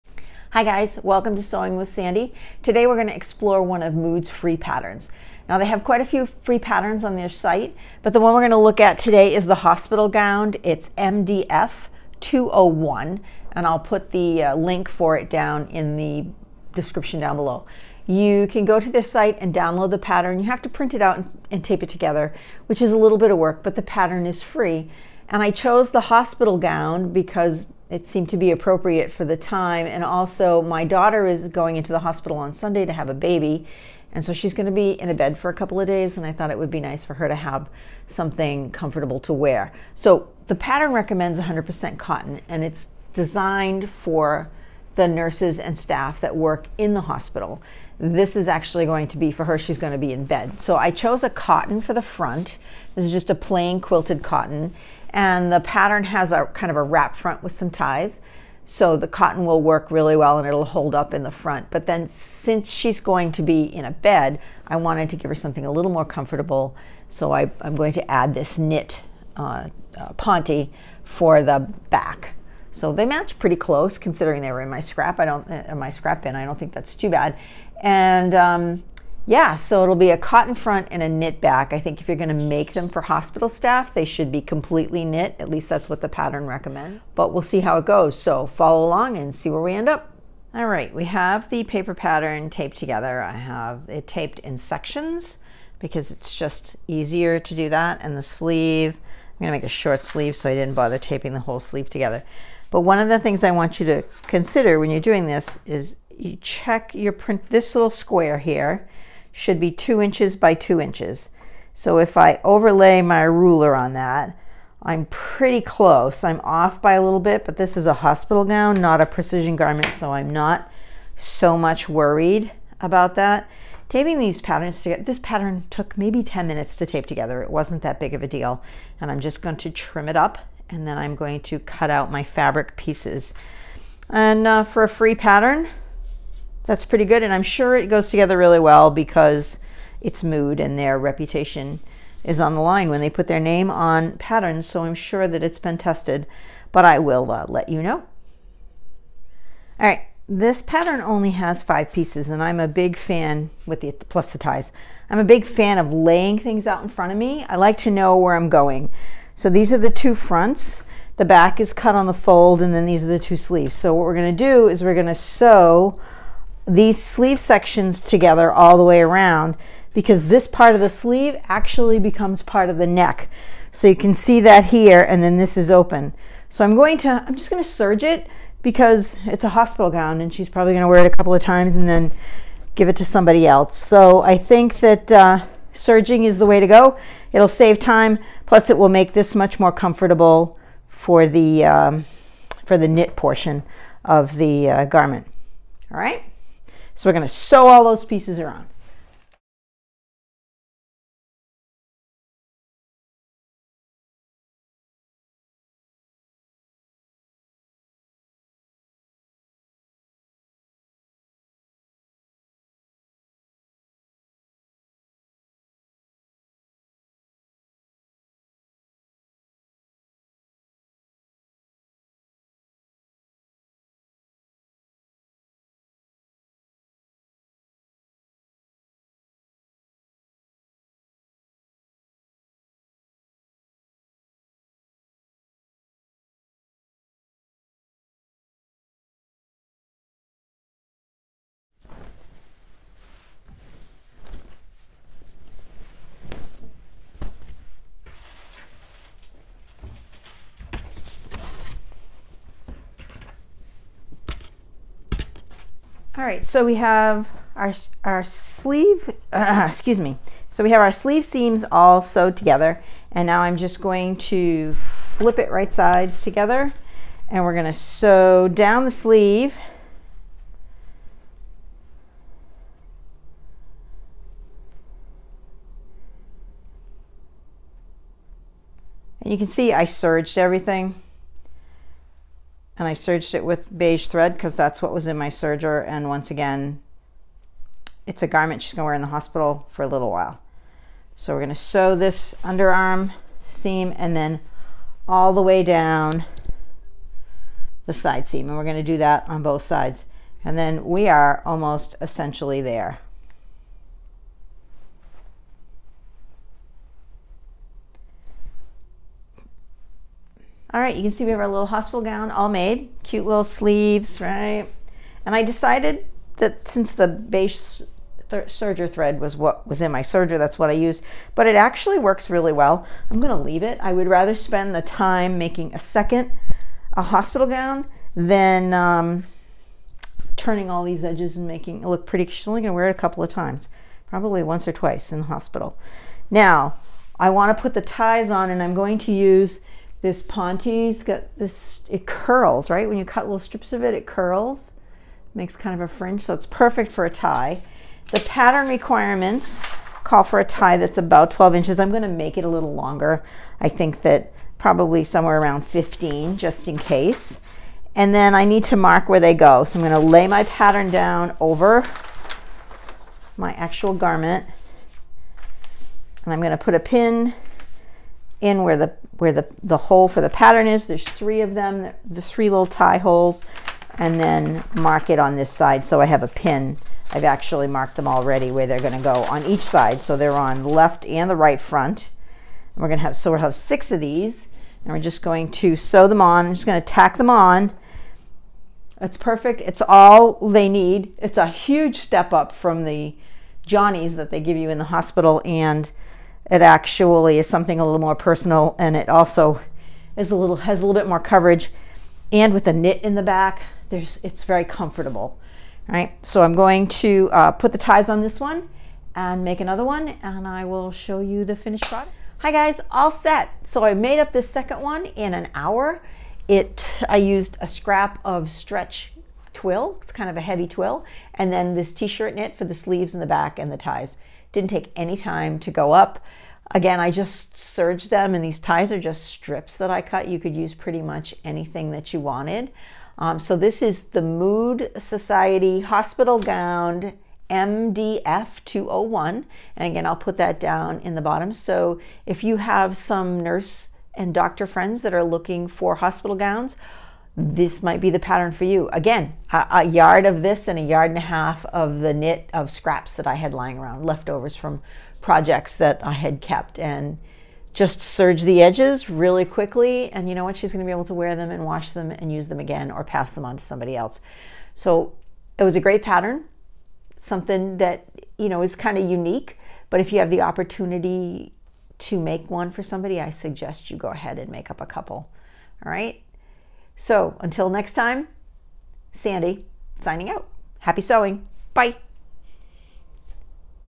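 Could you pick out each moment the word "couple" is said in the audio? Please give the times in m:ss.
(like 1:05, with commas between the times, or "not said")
0:35, 3:01, 5:33, 7:54.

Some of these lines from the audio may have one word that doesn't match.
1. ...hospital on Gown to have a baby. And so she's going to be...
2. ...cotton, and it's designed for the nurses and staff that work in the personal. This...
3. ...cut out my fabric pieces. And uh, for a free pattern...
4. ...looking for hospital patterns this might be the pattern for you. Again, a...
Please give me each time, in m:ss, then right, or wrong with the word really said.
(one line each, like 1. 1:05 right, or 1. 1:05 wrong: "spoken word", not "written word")
1. 0:31 wrong: "Sunday", not "Gown"
2. 0:41 wrong: "hospital", not "personal"
3. 2:11 right
4. 7:25 wrong: "gowns", not "patterns".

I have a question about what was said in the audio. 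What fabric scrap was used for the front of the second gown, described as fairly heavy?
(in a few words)
stretch twill.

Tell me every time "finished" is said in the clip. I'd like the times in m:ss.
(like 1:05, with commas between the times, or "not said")
6:51.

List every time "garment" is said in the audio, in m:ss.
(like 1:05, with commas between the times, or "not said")
1:59, 3:14, 4:48, 6:03.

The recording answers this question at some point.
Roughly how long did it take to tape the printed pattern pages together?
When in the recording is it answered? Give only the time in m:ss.
2:06.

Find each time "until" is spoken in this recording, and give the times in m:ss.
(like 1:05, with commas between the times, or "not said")
7:57.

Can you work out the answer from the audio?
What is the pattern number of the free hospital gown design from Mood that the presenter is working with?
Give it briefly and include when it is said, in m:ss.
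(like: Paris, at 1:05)
MDF 201, at 0:10.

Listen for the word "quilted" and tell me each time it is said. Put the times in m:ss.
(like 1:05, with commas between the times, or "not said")
0:53.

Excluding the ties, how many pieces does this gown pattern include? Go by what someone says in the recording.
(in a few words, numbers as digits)
5.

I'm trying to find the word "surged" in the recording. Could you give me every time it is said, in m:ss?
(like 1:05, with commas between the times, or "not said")
4:39.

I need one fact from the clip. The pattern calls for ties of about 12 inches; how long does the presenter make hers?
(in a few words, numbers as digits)
15 inches.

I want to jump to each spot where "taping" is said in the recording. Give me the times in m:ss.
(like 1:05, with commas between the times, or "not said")
1:40, 2:03.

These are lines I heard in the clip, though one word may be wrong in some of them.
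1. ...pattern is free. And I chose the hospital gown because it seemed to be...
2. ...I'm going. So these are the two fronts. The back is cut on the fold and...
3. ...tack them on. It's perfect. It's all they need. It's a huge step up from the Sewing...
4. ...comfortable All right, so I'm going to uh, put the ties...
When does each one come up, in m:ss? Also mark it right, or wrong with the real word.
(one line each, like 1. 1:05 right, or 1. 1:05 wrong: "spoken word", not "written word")
1. 0:23 right
2. 2:38 right
3. 6:26 wrong: "Johnnies", not "Sewing"
4. 6:44 right.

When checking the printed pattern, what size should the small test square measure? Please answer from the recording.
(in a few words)
2 inches by 2 inches.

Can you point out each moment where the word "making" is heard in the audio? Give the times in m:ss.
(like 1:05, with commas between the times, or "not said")
5:25, 5:31.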